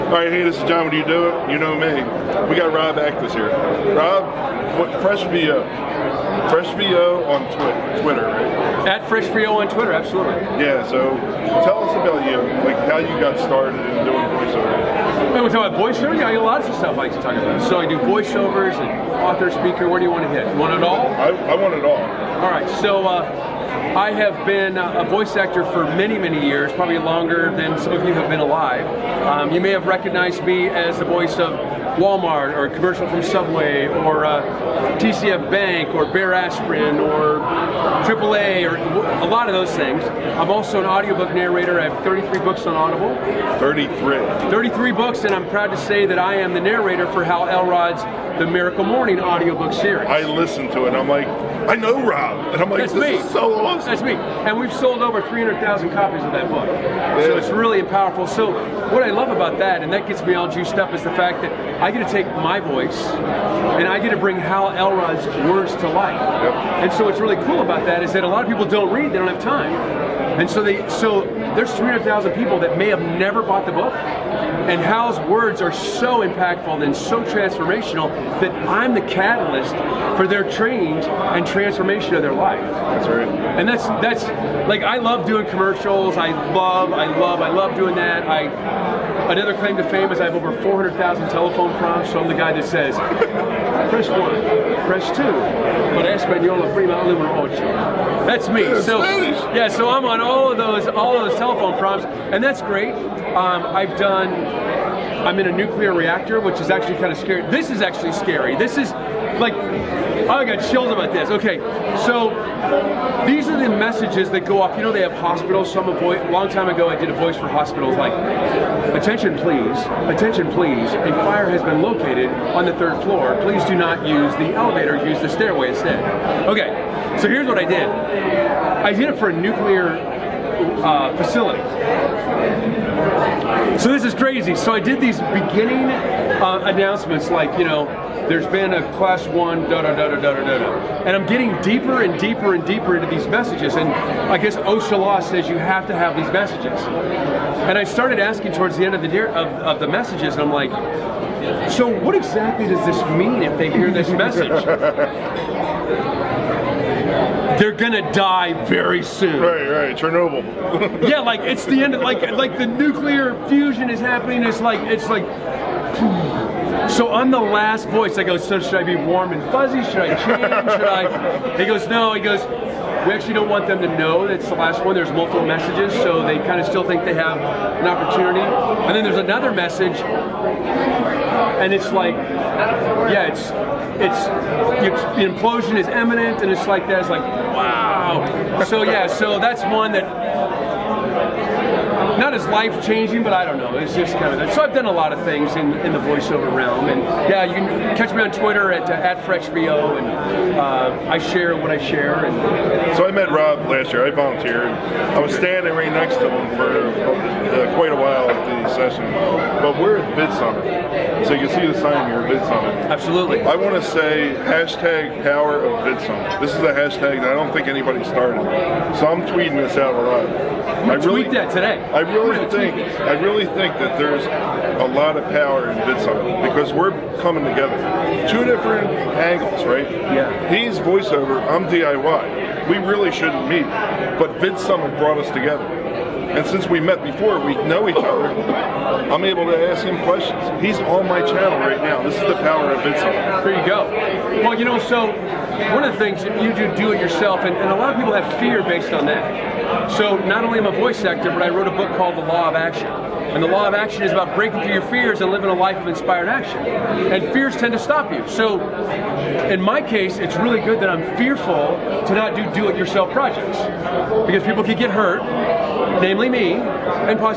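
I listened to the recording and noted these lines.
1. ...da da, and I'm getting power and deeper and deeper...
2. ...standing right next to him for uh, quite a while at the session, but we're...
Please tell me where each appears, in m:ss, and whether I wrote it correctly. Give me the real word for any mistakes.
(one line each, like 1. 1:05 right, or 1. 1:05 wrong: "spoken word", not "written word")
1. 2:20 wrong: "deeper", not "power"
2. 3:25 right.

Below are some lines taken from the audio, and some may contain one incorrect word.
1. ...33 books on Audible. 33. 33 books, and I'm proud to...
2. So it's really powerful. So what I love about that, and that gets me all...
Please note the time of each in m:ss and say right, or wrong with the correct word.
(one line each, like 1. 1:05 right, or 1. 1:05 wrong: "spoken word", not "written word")
1. 0:42 right
2. 0:57 right.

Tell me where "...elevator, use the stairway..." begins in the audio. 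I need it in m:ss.
2:04.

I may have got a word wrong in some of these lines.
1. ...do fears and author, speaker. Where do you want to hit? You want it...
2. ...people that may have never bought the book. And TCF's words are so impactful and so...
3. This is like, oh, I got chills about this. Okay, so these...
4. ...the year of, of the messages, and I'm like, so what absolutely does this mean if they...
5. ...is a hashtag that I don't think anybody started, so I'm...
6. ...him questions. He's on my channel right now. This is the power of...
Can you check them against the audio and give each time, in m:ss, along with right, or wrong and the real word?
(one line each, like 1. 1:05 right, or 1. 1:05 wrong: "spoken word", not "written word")
1. 0:17 wrong: "voiceovers", not "fears"
2. 1:12 wrong: "Hal", not "TCF"
3. 1:48 right
4. 2:29 wrong: "exactly", not "absolutely"
5. 3:36 right
6. 3:59 right.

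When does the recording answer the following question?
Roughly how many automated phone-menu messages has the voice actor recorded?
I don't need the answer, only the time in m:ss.
1:30.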